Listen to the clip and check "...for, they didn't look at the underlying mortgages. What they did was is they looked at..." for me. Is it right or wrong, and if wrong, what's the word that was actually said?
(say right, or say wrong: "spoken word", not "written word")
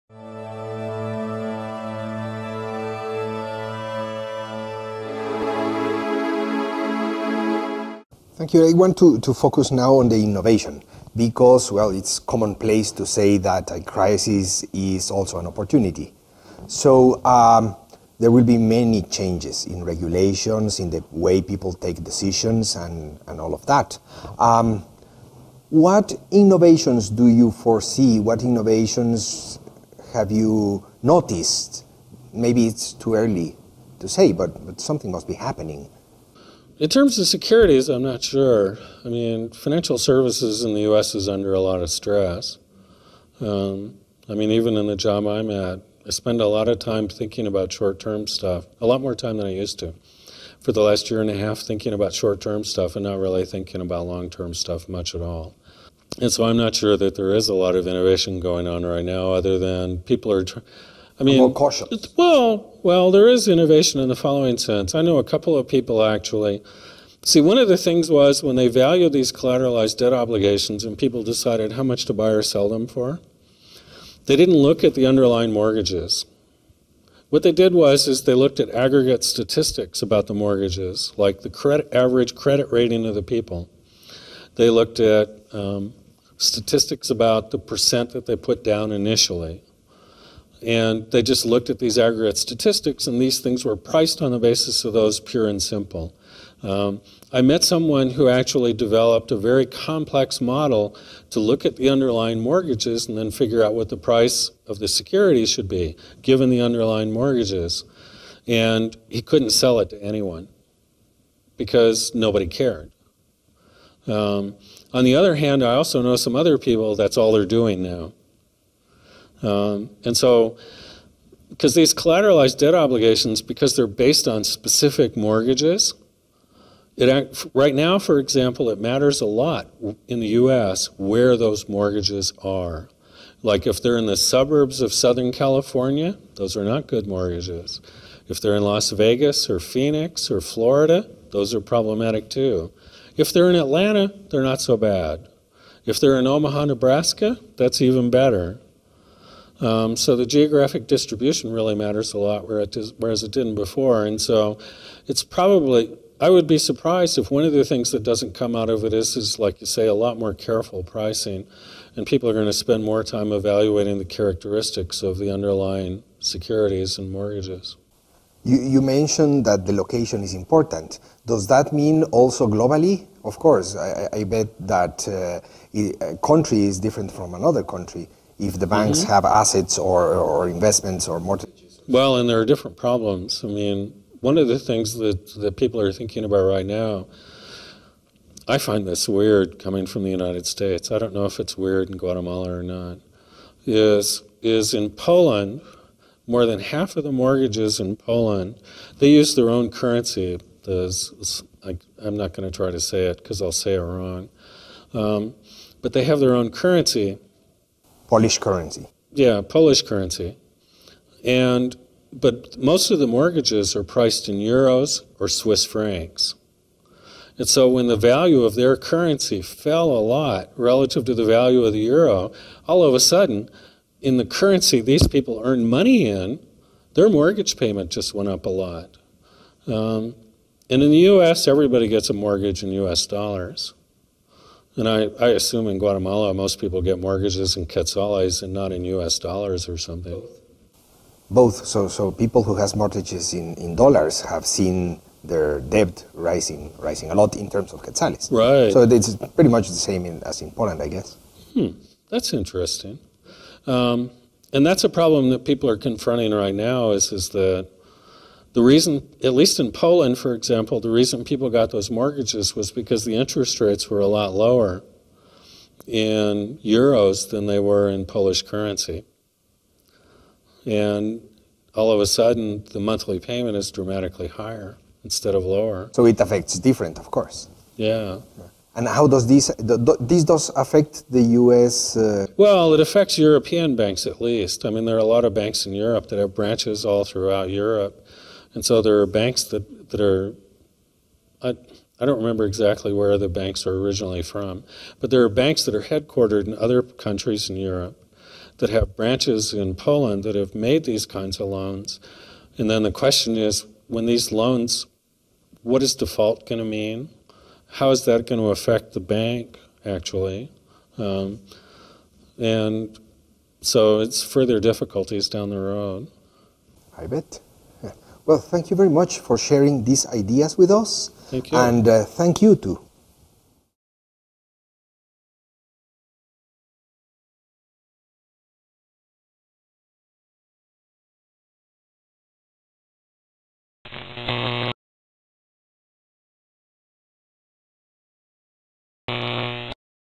right.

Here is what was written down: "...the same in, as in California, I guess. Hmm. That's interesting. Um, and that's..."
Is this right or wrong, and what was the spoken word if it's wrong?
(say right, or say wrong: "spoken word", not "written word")
wrong: "Poland", not "California".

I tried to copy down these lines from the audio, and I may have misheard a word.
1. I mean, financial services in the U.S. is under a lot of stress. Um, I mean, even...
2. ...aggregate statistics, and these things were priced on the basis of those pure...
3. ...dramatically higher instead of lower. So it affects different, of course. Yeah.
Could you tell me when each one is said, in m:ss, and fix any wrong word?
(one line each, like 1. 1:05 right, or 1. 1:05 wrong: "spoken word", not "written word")
1. 0:39 right
2. 1:31 right
3. 4:33 right.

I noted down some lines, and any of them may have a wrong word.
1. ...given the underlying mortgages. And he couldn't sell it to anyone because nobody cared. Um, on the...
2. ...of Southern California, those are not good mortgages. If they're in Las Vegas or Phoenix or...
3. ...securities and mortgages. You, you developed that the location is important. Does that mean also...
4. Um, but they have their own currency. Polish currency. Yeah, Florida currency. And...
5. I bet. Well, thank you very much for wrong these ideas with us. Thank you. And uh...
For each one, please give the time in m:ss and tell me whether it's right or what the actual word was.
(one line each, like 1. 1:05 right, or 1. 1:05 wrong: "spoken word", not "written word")
1. 1:46 right
2. 2:14 right
3. 2:46 wrong: "mentioned", not "developed"
4. 3:24 wrong: "Polish", not "Florida"
5. 5:16 wrong: "sharing", not "wrong".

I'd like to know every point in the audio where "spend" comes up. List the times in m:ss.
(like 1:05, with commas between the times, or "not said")
0:46, 2:42.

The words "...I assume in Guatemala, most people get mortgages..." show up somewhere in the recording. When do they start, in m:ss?
3:55.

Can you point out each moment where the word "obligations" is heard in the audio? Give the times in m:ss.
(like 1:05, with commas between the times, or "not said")
1:10, 2:02.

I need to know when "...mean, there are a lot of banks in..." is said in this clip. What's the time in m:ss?
4:44.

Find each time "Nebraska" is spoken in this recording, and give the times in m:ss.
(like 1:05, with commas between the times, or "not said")
2:26.